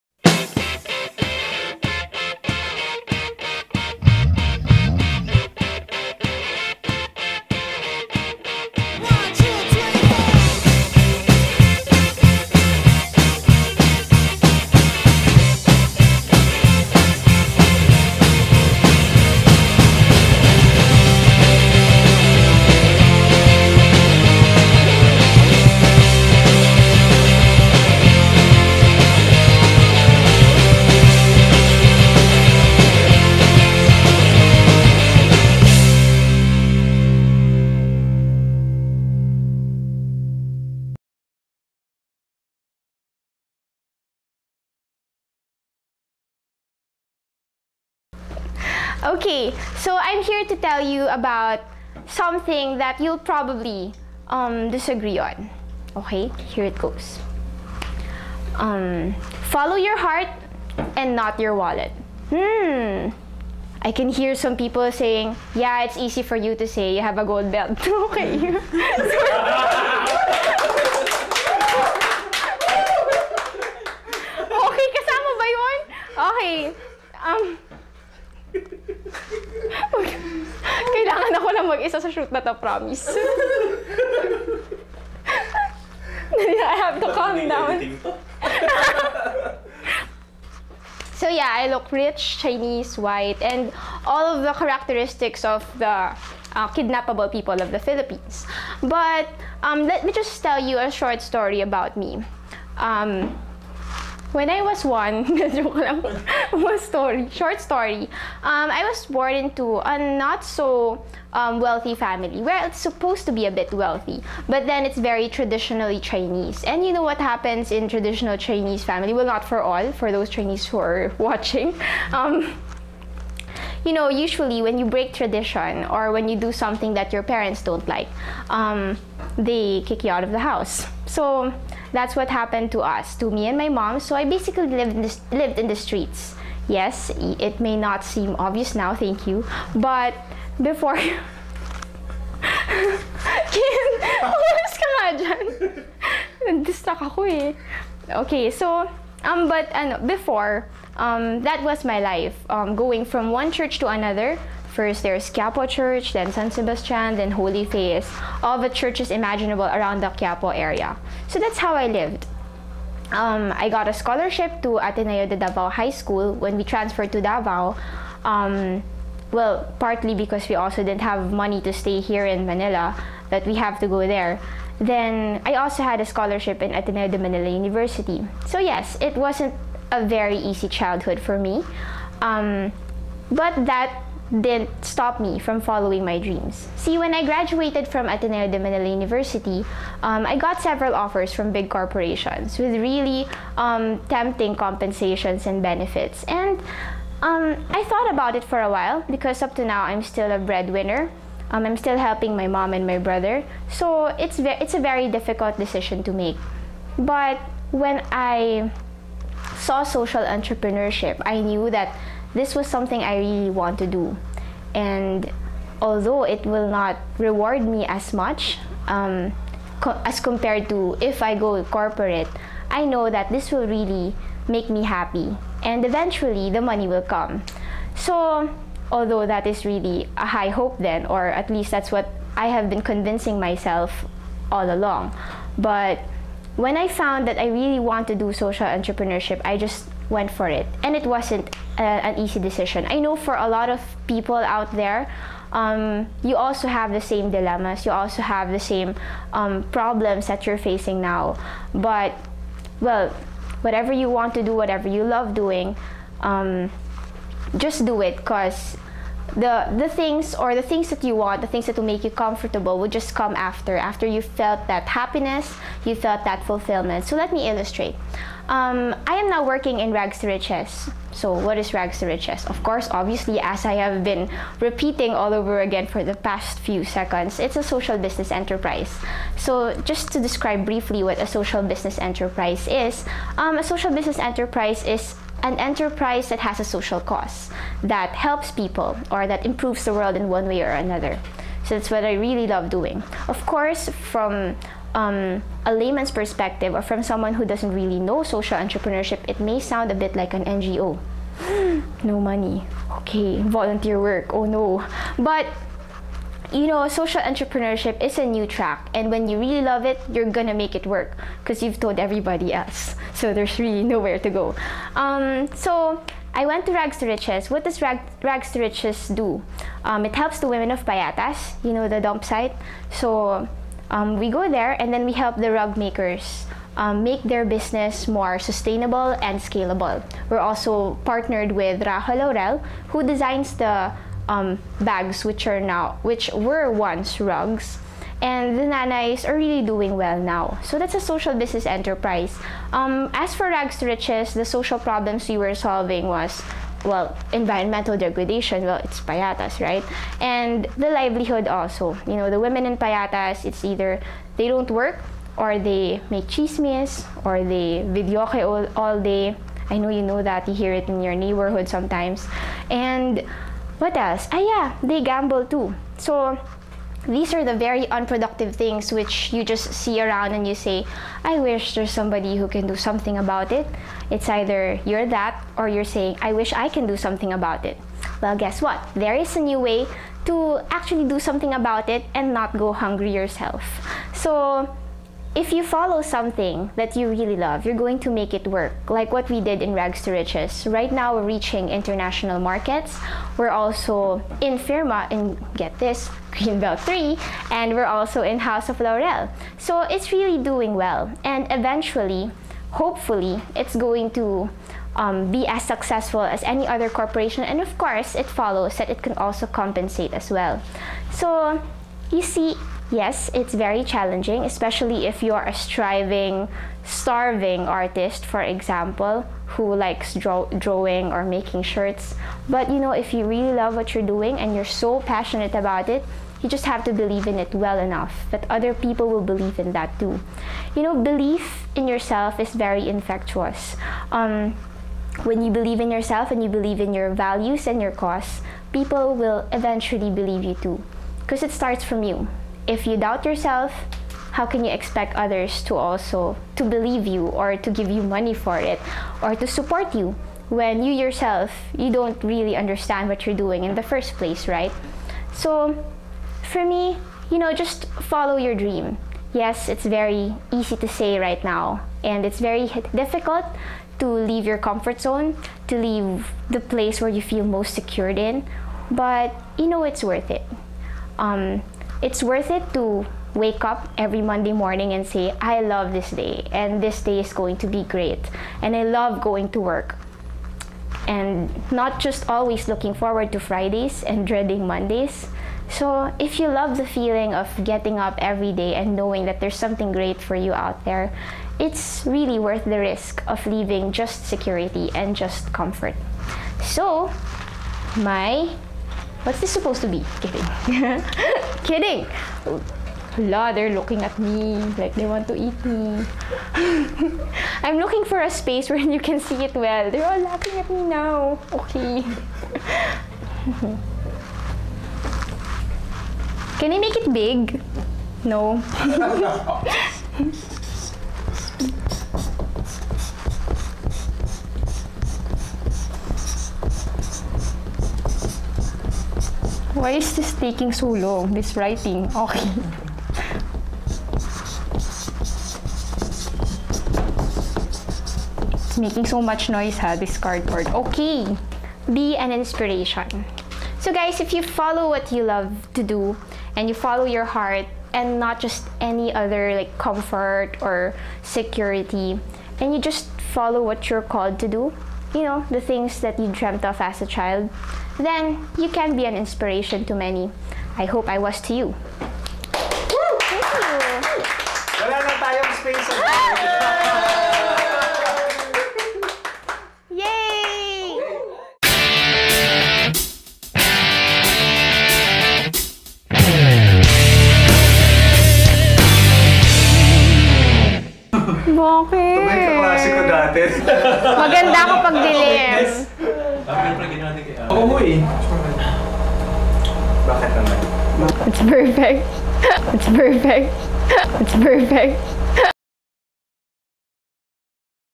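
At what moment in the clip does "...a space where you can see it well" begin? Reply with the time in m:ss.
8:28.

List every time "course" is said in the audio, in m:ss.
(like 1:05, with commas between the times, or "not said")
4:32, 4:53, 6:47.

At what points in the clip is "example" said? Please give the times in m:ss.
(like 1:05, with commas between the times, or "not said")
6:58.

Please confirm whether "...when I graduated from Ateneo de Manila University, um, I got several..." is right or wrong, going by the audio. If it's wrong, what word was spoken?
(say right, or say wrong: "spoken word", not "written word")
right.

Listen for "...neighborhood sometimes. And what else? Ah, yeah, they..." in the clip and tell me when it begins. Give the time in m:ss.
6:01.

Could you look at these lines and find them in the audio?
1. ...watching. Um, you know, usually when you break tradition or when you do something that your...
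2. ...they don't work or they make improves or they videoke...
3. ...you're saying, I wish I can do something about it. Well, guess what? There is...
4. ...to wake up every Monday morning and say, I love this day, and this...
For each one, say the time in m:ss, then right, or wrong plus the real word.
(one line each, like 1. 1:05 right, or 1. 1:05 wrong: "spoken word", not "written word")
1. 2:01 right
2. 5:54 wrong: "chismes", not "improves"
3. 6:15 right
4. 7:52 right.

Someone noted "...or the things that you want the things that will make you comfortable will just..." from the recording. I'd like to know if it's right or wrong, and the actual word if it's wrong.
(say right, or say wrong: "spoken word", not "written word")
right.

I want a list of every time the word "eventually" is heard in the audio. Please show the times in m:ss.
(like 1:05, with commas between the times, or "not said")
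3:45, 6:41, 7:19.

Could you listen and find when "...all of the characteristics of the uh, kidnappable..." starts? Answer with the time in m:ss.
1:34.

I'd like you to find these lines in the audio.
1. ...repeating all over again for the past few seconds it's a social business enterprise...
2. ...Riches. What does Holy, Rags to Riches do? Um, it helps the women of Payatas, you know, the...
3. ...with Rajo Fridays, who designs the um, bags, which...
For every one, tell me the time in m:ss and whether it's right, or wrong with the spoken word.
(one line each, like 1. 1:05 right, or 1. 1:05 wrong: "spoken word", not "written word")
1. 4:34 right
2. 5:17 wrong: "Rag", not "Holy"
3. 5:31 wrong: "Laurel", not "Fridays".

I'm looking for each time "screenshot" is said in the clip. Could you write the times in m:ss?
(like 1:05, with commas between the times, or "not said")
not said.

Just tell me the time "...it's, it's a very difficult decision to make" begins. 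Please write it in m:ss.
3:24.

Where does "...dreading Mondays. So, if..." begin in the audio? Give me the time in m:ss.
8:04.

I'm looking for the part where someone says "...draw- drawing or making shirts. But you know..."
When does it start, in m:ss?
7:00.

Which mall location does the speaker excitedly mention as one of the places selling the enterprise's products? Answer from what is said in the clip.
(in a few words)
Greenbelt 3.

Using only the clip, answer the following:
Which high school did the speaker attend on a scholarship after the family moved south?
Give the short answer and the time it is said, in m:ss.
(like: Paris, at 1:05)
Ateneo de Davao High School, at 2:44.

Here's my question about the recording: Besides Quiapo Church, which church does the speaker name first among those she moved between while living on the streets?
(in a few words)
San Sebastian.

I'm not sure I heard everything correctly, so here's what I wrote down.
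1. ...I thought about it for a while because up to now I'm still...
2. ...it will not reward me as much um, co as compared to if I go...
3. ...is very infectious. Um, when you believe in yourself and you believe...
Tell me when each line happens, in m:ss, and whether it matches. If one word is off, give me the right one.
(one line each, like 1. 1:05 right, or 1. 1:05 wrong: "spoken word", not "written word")
1. 3:17 right
2. 3:36 right
3. 7:12 right.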